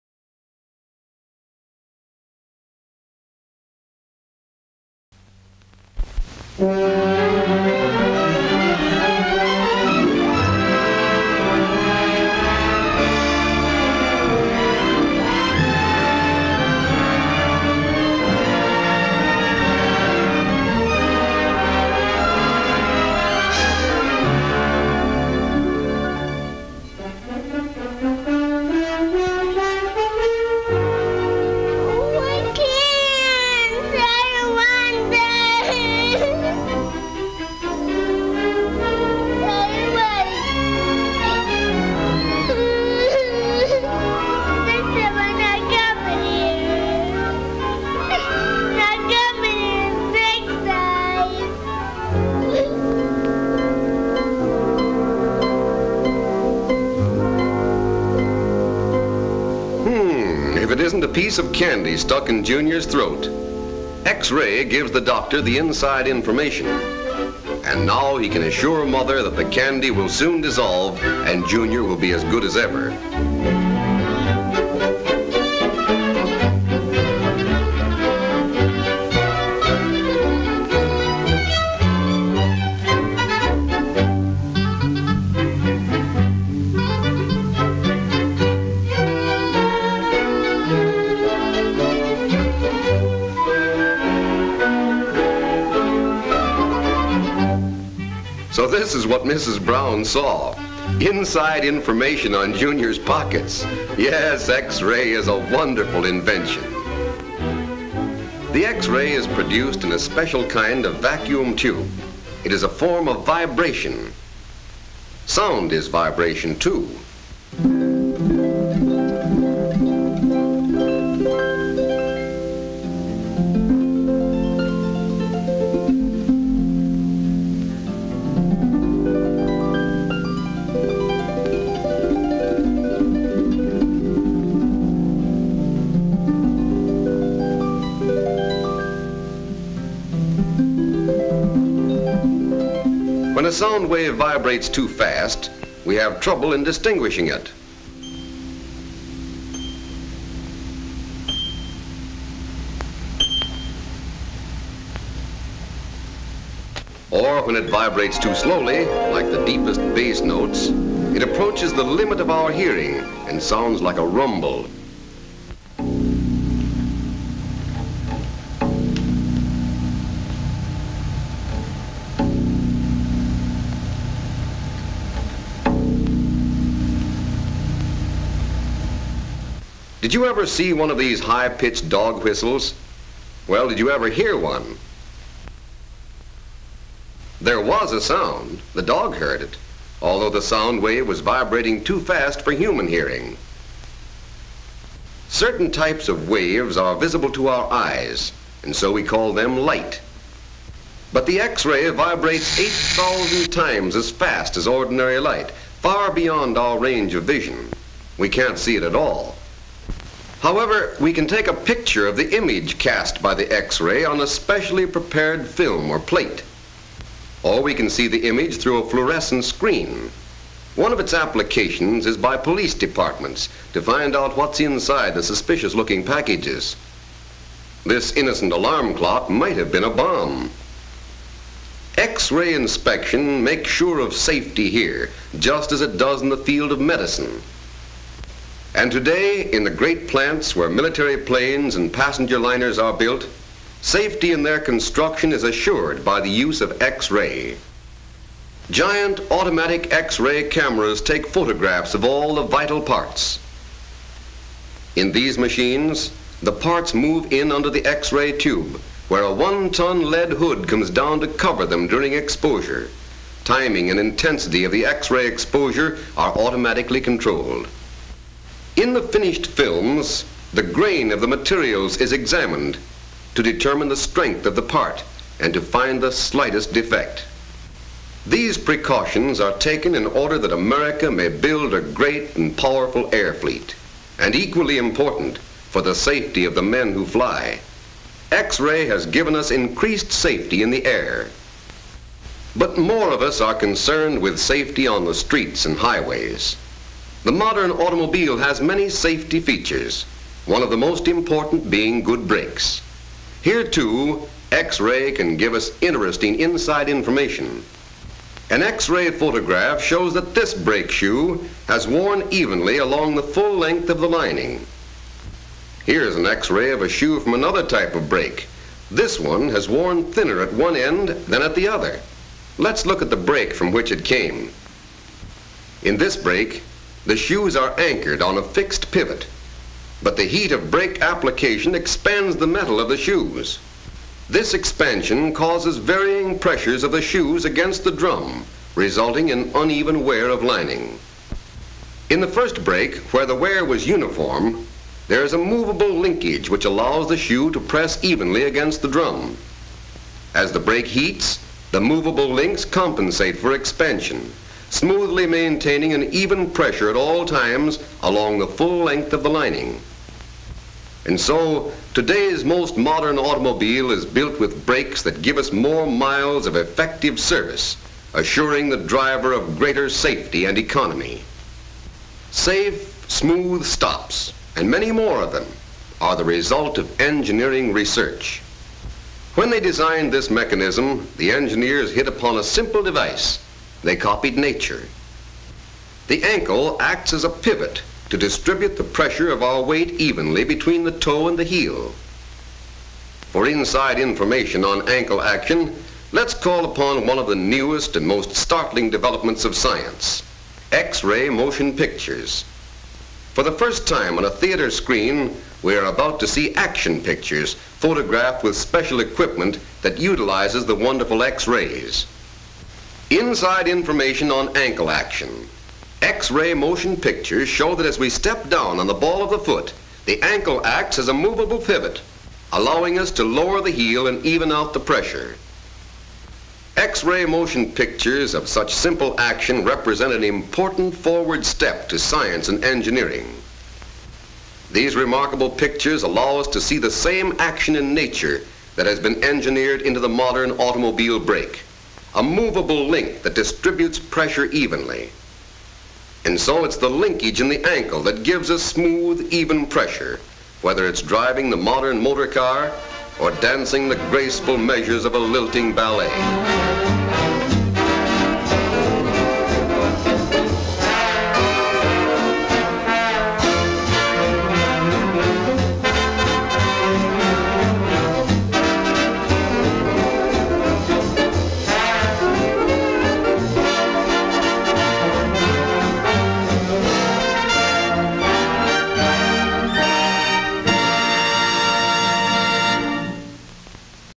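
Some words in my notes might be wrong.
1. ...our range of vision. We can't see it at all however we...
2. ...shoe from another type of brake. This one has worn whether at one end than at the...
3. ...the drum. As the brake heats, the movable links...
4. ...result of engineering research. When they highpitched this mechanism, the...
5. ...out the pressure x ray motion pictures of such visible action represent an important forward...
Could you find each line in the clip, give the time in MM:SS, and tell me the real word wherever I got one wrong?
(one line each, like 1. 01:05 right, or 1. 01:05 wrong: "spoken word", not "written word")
1. 03:26 right
2. 05:16 wrong: "thinner", not "whether"
3. 05:48 right
4. 06:16 wrong: "designed", not "highpitched"
5. 07:04 wrong: "simple", not "visible".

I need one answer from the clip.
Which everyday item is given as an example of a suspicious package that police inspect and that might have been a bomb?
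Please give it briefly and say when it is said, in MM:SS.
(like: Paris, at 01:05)
alarm clock, at 03:48.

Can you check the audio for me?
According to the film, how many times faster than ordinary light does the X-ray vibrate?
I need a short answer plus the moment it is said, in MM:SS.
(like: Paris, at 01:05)
8,000, at 03:22.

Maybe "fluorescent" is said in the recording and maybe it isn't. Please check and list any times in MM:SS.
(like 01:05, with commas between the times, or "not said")
03:38.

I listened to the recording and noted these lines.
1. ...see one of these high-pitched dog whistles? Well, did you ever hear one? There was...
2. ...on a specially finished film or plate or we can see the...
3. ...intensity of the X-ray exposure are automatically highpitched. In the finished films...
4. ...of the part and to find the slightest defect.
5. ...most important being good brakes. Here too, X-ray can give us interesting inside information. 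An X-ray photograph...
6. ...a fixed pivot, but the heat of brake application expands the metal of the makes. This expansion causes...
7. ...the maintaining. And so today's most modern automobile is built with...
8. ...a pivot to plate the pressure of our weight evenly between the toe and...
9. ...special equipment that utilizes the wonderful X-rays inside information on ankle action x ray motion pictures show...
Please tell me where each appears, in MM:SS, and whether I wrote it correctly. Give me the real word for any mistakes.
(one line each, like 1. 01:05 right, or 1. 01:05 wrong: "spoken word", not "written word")
1. 03:00 right
2. 03:34 wrong: "prepared", not "finished"
3. 04:23 wrong: "controlled", not "highpitched"
4. 04:34 right
5. 05:00 right
6. 05:28 wrong: "shoes", not "makes"
7. 05:59 wrong: "lining", not "maintaining"
8. 06:27 wrong: "distribute", not "plate"
9. 06:48 right.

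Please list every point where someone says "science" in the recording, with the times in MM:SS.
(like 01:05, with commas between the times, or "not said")
06:39, 07:11.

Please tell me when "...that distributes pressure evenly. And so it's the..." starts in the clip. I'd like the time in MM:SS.
07:23.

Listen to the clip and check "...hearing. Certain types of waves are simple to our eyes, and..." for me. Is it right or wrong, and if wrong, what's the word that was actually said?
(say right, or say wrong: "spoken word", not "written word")
wrong: "visible", not "simple".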